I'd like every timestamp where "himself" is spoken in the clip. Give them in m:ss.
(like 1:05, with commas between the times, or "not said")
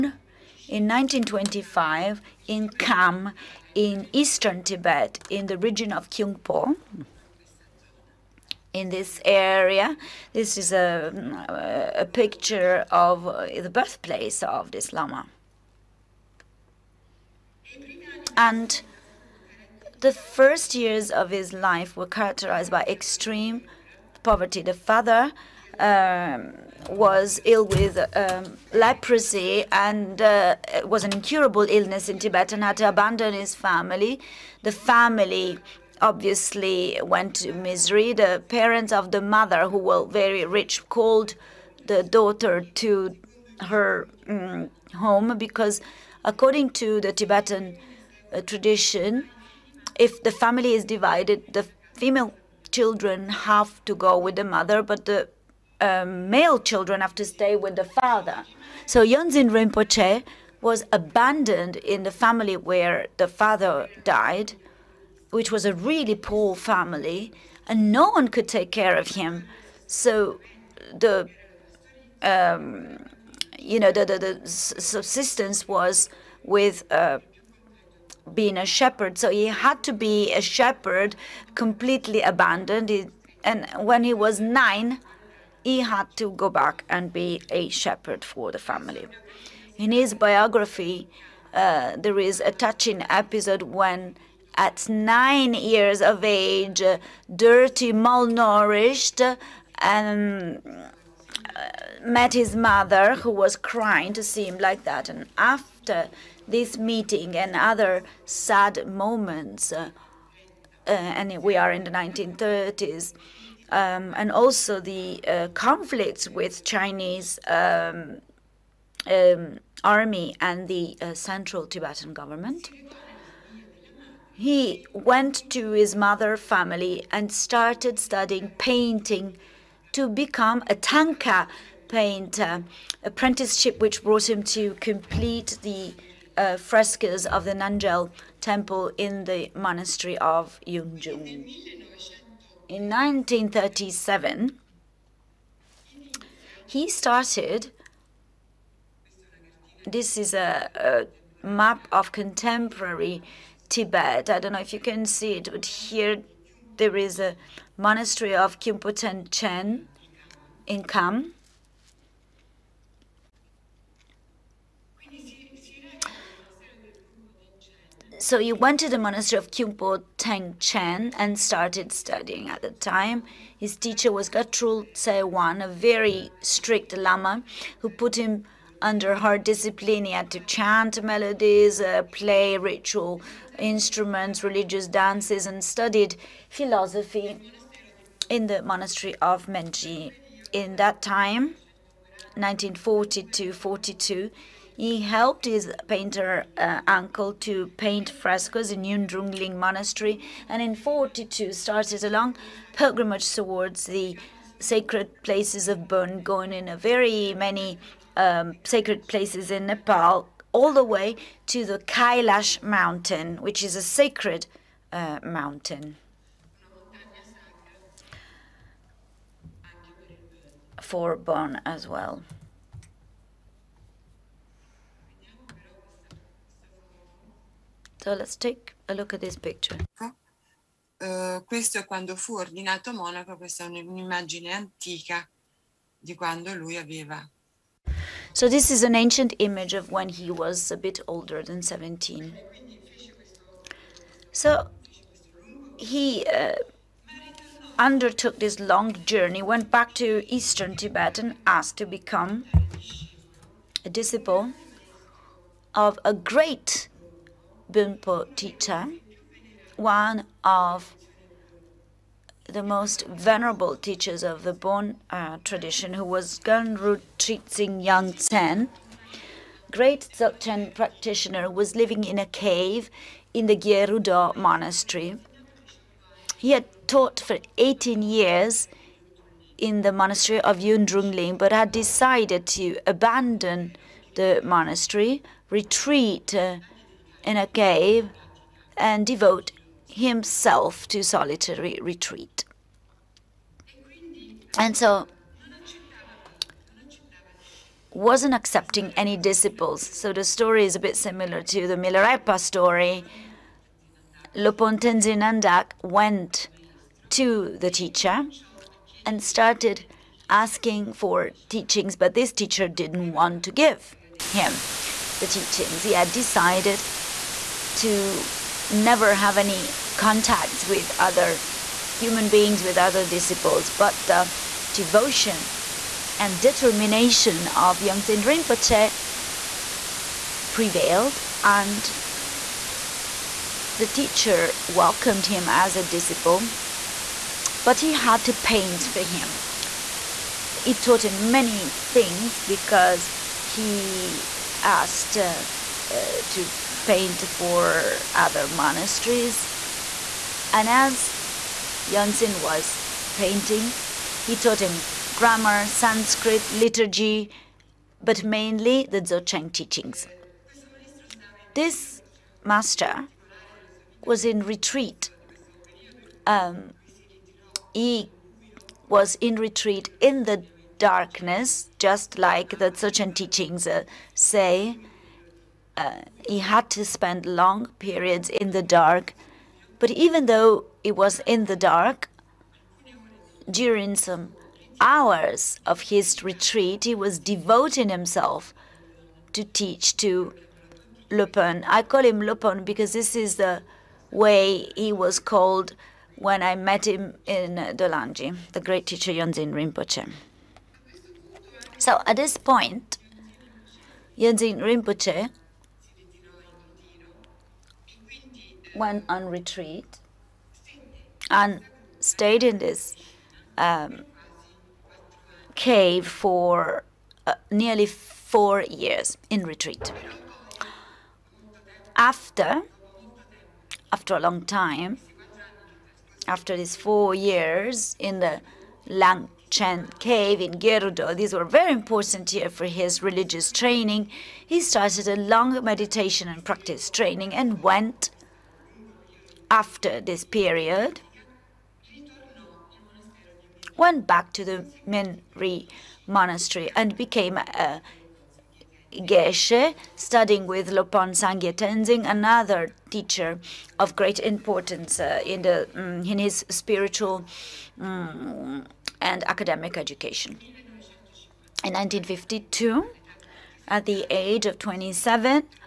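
4:49, 6:27.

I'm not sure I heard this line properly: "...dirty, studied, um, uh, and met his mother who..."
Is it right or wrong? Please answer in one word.
wrong.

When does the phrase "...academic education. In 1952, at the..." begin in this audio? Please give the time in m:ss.
7:39.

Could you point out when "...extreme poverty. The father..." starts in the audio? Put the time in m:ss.
0:22.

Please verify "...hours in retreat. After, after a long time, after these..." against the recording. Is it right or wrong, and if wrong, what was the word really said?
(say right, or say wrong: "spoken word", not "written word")
wrong: "years", not "hours".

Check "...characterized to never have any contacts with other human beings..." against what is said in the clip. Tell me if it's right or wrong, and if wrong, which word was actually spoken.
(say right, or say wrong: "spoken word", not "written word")
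wrong: "decided", not "characterized".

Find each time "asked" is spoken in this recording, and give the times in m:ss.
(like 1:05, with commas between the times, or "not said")
4:11, 5:44.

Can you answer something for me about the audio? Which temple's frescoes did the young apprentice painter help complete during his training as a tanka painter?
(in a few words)
Nanjel temple.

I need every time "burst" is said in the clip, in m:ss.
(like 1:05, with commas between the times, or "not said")
not said.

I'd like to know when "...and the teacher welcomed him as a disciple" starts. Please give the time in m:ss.
5:31.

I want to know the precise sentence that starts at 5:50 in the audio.
And as Yongdzin was painting, he taught him grammar, Sanskrit, liturgy, but mainly the Dzogchen teachings.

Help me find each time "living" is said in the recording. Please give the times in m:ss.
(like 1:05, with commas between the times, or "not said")
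4:31.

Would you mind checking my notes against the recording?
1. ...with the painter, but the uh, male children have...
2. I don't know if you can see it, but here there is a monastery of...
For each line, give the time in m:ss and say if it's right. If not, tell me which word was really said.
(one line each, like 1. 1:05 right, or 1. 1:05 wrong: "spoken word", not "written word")
1. 0:54 wrong: "mother", not "painter"
2. 2:34 right.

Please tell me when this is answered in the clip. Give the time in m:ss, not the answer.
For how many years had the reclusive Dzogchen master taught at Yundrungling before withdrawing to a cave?
4:37.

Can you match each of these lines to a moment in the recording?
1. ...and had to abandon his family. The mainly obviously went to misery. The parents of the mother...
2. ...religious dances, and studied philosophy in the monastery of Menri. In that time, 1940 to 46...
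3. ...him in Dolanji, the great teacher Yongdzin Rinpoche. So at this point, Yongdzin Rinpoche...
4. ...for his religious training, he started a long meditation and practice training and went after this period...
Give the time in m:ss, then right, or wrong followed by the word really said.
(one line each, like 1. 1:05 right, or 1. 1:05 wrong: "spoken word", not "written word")
1. 0:32 wrong: "family", not "mainly"
2. 3:04 wrong: "42", not "46"
3. 6:36 right
4. 7:12 right.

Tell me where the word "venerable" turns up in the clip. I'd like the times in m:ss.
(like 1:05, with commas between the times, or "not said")
4:23.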